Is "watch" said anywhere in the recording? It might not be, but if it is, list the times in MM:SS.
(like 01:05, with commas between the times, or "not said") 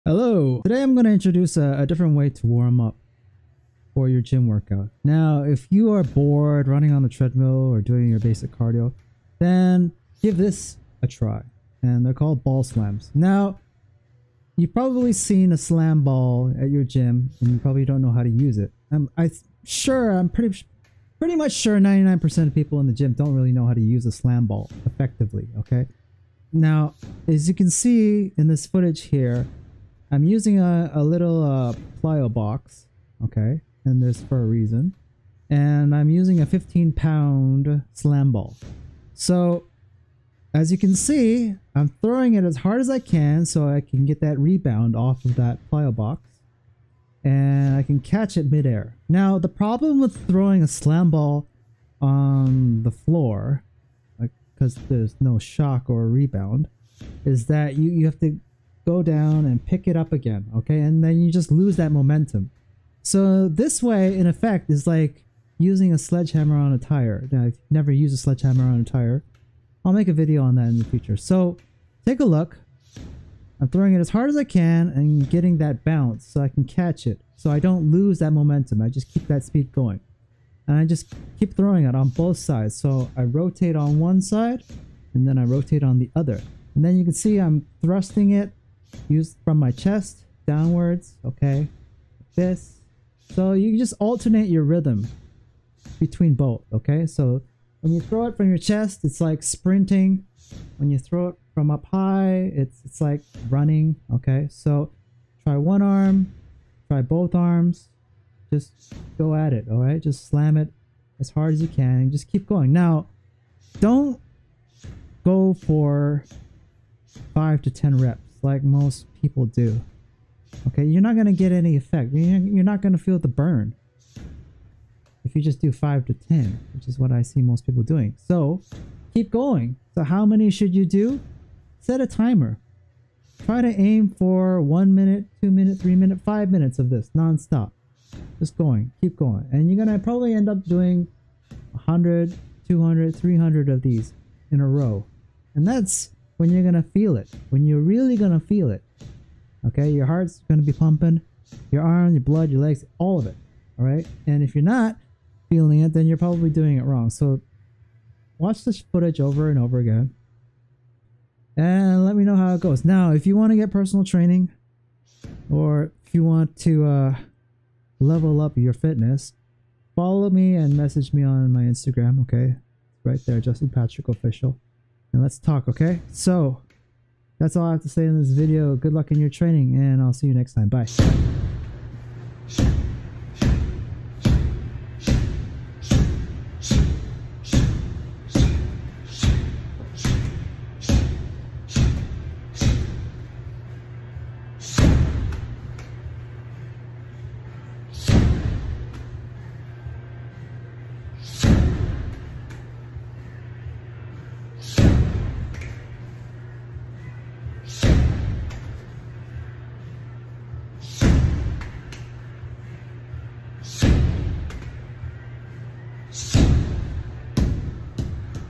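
02:38.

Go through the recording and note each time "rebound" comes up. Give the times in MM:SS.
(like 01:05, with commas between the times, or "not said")
00:44, 00:56.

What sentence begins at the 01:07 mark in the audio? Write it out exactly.
Now, I've never used a sledgehammer on a tire.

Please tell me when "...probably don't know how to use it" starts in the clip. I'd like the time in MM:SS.
00:17.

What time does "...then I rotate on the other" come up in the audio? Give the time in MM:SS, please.
01:25.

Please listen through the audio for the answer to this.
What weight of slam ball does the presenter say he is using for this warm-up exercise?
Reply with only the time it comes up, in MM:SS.
00:36.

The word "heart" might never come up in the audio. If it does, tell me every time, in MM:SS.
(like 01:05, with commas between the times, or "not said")
02:30.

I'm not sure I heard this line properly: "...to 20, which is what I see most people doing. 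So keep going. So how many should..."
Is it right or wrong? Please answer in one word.
wrong.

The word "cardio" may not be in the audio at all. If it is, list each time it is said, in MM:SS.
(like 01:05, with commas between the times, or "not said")
00:08.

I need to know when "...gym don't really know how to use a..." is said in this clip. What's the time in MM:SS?
00:22.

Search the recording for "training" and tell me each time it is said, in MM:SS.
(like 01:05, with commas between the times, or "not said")
02:44, 02:59.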